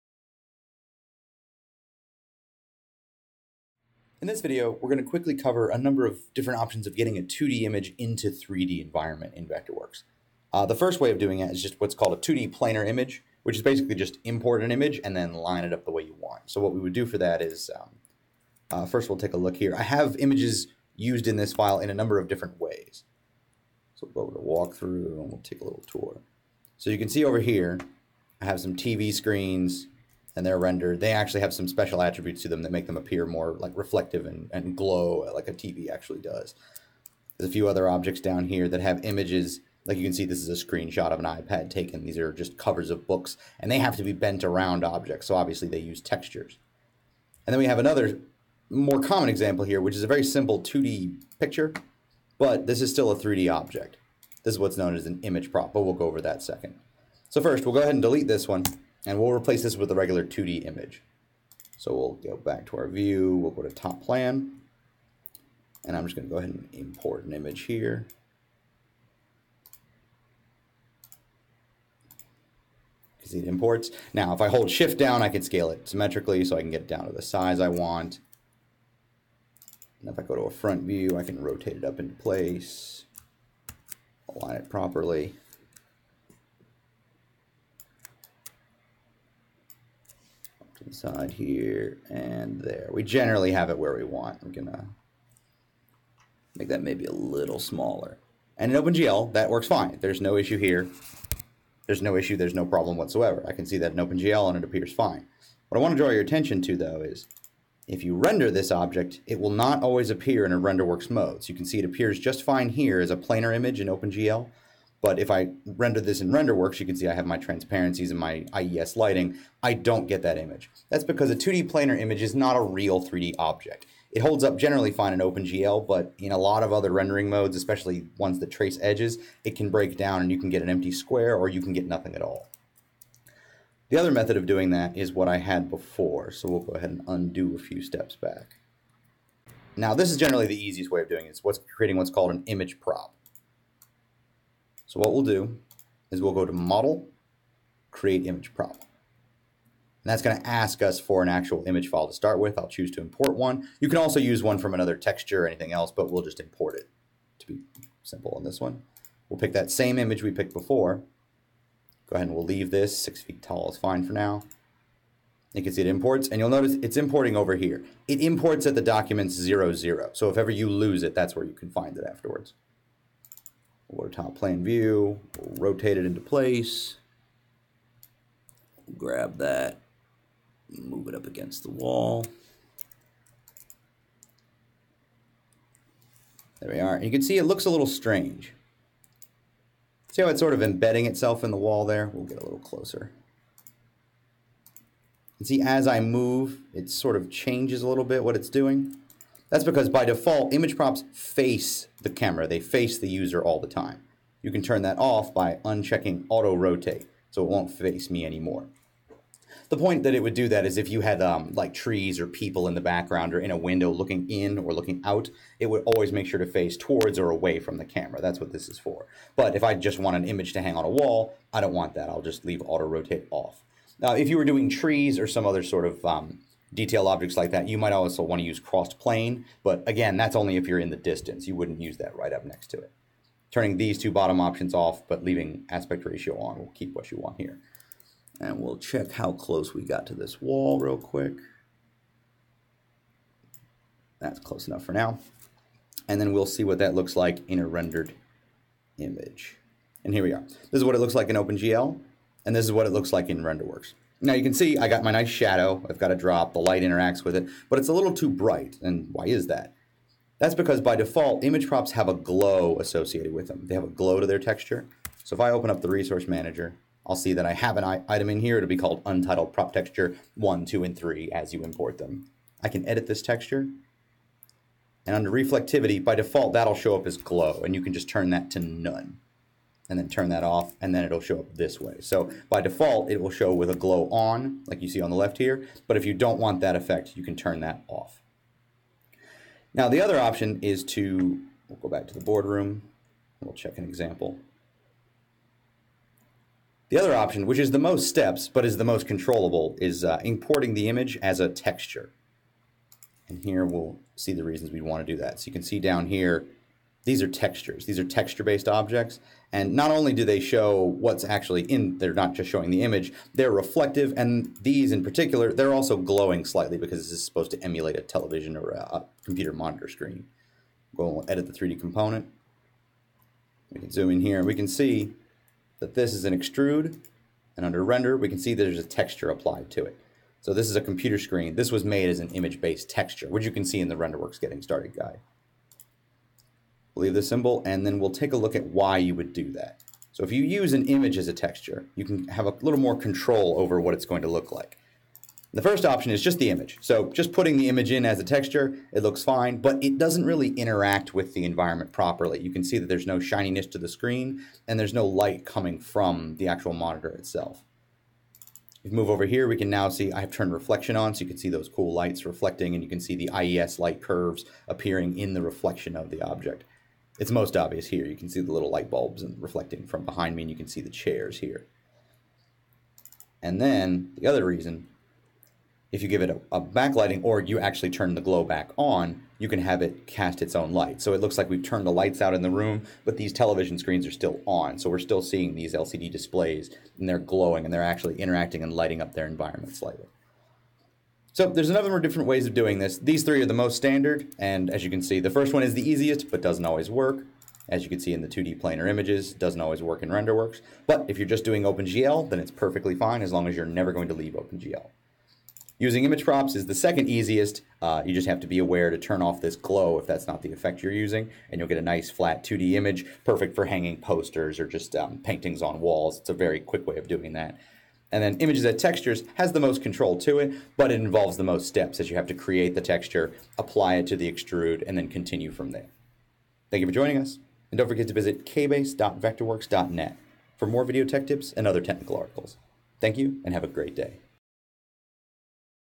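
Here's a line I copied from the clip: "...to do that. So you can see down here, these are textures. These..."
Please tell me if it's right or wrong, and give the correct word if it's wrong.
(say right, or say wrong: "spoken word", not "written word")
right.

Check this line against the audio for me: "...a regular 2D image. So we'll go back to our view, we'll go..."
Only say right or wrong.
right.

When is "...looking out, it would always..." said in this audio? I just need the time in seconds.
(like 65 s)
214 s.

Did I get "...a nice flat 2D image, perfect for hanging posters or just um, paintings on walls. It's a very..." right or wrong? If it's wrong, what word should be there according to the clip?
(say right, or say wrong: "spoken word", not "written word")
right.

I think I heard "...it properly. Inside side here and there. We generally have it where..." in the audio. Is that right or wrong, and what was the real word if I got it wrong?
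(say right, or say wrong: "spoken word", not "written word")
right.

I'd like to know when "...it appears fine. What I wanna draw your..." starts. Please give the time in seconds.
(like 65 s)
104 s.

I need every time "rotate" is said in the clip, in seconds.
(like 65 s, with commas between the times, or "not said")
81 s, 175 s, 206 s, 222 s.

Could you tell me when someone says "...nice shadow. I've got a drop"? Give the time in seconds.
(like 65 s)
255 s.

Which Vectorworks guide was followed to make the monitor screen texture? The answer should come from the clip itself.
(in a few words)
RenderWorks Getting Started guide.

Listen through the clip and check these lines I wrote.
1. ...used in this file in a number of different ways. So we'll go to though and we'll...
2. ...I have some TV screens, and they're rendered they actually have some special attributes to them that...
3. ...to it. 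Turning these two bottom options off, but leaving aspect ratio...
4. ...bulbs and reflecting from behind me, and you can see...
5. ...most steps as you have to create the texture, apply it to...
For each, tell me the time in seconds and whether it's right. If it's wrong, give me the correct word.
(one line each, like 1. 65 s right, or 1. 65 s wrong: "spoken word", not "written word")
1. 20 s wrong: "walkthrough", not "though"
2. 28 s right
3. 232 s right
4. 368 s right
5. 421 s right.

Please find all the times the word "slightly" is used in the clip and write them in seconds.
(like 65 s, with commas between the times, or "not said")
316 s, 389 s.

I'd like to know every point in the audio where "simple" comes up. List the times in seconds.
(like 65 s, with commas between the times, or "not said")
50 s, 158 s.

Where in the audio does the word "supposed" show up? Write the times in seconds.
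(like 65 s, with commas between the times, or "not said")
317 s.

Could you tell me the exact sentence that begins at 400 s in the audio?
But if you're just doing OpenGL, then it's perfectly fine as long as you're never going to leave OpenGL.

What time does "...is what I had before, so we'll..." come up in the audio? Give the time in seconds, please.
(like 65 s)
134 s.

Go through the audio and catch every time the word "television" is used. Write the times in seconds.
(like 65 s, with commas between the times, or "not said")
318 s, 383 s.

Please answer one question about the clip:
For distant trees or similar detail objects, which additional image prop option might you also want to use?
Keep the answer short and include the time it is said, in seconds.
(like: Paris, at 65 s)
Crossed plane, at 228 s.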